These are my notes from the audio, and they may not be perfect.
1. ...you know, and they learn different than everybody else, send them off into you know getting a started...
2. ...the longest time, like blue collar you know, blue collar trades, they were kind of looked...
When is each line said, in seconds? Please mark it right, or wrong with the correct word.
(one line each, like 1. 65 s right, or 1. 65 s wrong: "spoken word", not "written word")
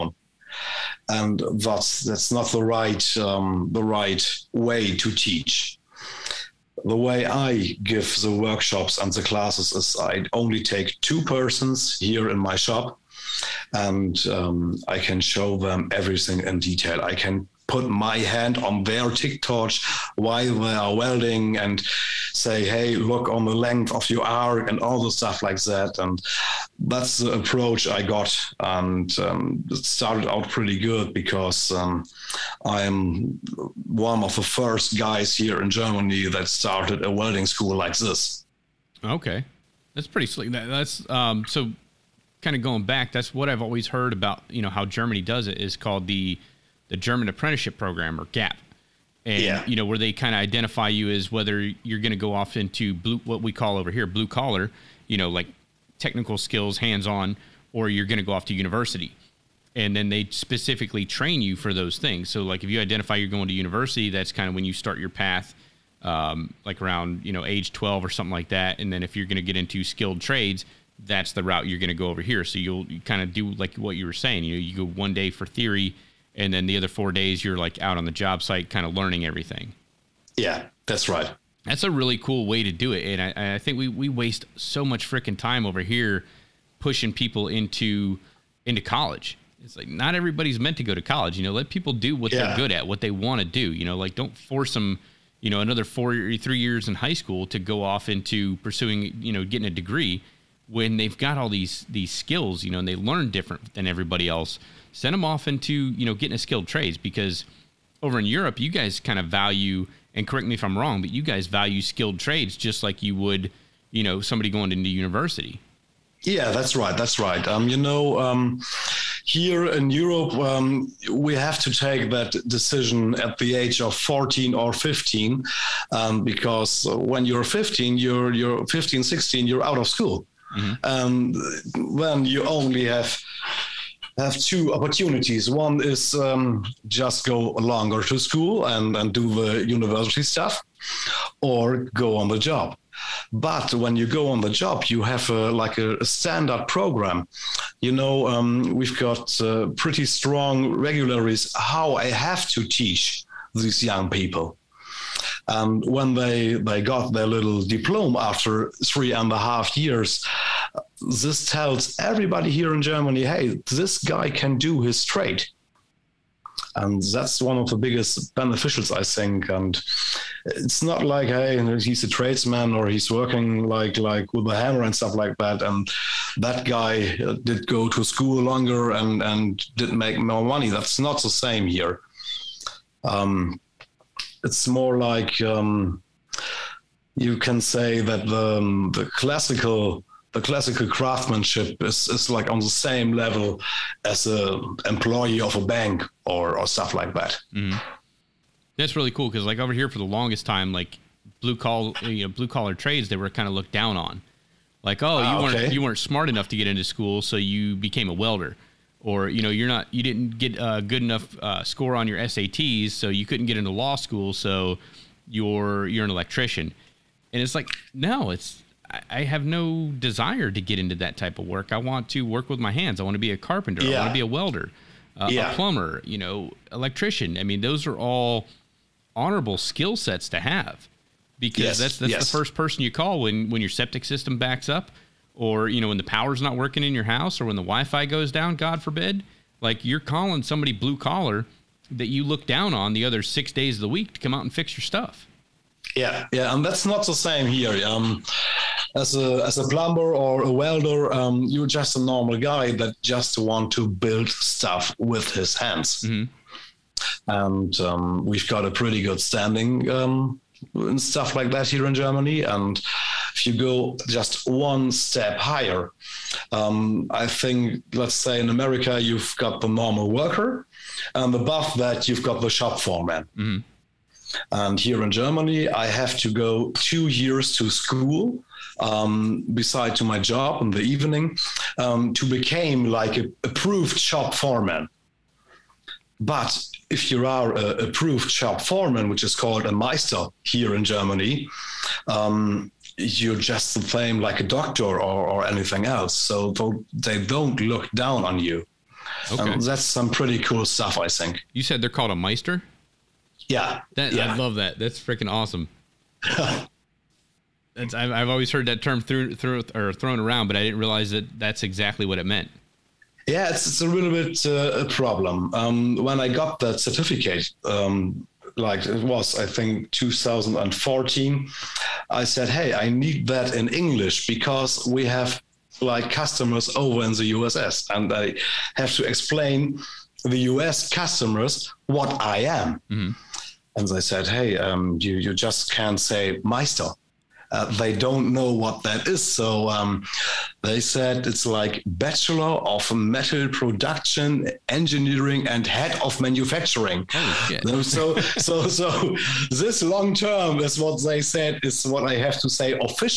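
1. 102 s wrong: "skilled", not "started"
2. 199 s right.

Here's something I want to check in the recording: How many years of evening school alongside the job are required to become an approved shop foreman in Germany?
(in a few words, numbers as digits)
2.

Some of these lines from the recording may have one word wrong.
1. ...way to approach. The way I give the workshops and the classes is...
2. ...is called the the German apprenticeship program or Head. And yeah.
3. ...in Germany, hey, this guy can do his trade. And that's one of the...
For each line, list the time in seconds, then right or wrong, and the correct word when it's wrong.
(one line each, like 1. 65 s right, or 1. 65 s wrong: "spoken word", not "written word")
1. 4 s wrong: "teach", not "approach"
2. 45 s wrong: "GAP", not "Head"
3. 162 s right.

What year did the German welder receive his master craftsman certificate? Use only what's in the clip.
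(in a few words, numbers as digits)
2014.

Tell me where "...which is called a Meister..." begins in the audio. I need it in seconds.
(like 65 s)
289 s.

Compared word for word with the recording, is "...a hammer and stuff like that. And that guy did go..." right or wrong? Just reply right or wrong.
right.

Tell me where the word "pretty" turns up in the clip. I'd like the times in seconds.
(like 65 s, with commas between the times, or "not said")
30 s, 40 s, 149 s, 258 s, 300 s.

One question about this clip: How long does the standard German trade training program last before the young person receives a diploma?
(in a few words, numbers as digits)
3.5 years.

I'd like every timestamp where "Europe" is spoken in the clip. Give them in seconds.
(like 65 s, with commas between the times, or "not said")
108 s, 119 s.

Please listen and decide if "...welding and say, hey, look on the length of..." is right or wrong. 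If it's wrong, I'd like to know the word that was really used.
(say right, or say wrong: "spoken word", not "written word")
right.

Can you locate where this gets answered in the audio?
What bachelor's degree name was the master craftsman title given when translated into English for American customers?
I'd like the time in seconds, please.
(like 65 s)
341 s.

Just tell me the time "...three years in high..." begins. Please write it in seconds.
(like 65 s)
96 s.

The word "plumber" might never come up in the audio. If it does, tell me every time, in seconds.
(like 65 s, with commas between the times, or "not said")
225 s, 249 s.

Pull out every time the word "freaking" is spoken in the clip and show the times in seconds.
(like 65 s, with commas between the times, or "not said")
85 s, 305 s.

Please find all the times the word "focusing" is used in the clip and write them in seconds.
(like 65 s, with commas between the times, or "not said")
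not said.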